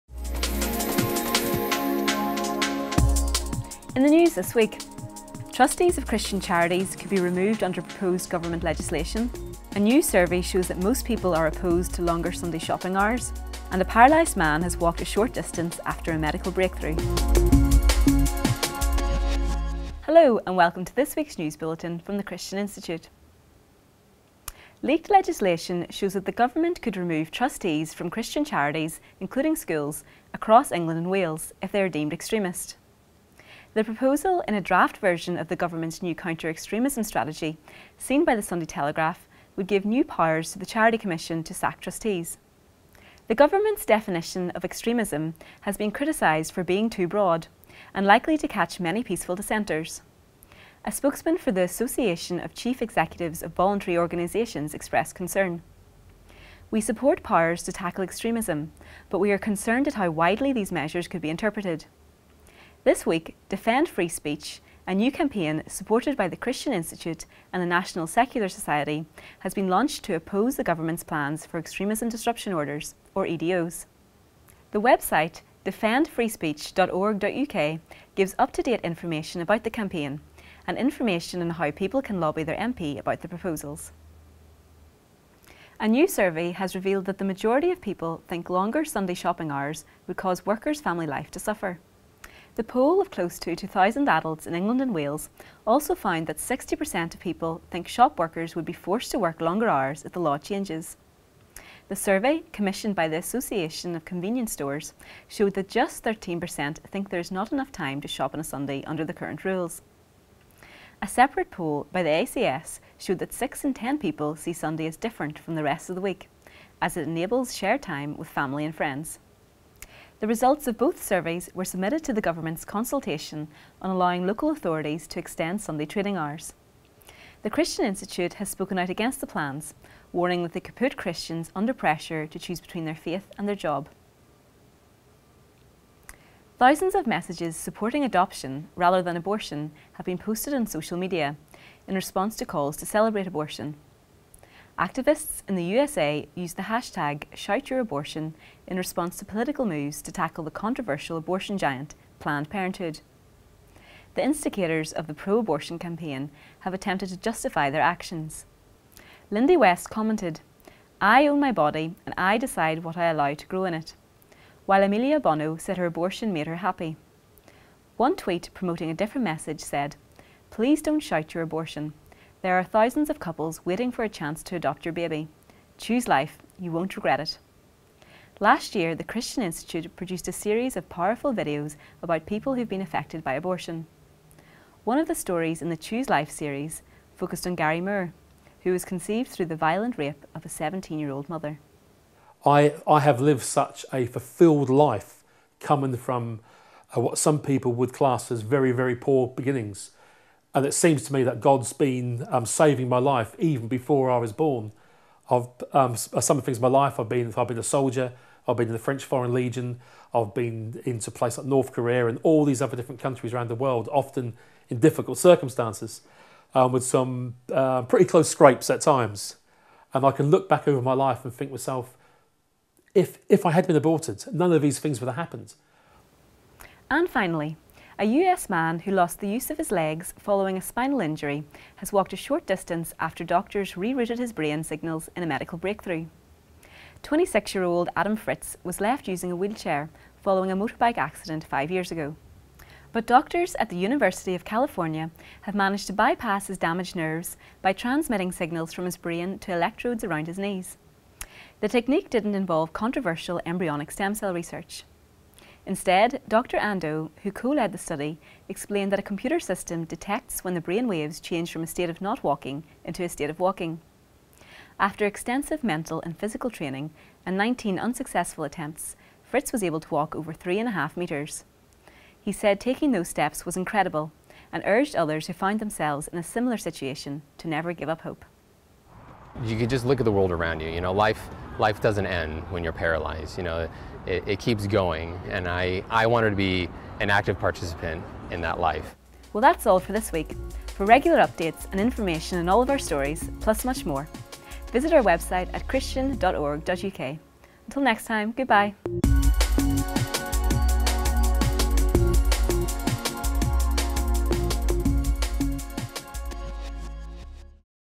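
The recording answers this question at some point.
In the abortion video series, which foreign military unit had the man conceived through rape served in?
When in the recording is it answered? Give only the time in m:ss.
3:28.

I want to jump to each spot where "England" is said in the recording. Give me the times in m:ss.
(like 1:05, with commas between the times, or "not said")
0:30, 1:34.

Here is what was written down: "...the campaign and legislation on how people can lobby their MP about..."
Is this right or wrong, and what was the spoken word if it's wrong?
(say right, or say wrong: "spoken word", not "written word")
wrong: "information", not "legislation".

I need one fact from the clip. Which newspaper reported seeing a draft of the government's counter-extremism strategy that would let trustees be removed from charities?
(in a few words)
Sunday Telegraph.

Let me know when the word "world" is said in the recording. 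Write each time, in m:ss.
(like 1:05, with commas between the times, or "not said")
3:33, 4:40.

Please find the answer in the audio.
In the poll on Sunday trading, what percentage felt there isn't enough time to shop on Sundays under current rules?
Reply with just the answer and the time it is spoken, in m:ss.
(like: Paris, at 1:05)
13%, at 1:46.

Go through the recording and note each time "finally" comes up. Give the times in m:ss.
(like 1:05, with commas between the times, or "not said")
3:47.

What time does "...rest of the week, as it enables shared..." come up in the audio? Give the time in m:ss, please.
1:55.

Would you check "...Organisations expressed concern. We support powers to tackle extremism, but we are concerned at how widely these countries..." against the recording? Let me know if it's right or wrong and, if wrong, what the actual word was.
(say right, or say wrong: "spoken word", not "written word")
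wrong: "measures", not "countries".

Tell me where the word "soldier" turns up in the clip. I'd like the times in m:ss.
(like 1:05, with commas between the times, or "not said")
3:27.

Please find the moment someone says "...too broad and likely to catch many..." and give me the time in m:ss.
0:46.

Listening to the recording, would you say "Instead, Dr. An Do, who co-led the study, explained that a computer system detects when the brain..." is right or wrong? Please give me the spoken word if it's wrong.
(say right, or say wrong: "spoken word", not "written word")
right.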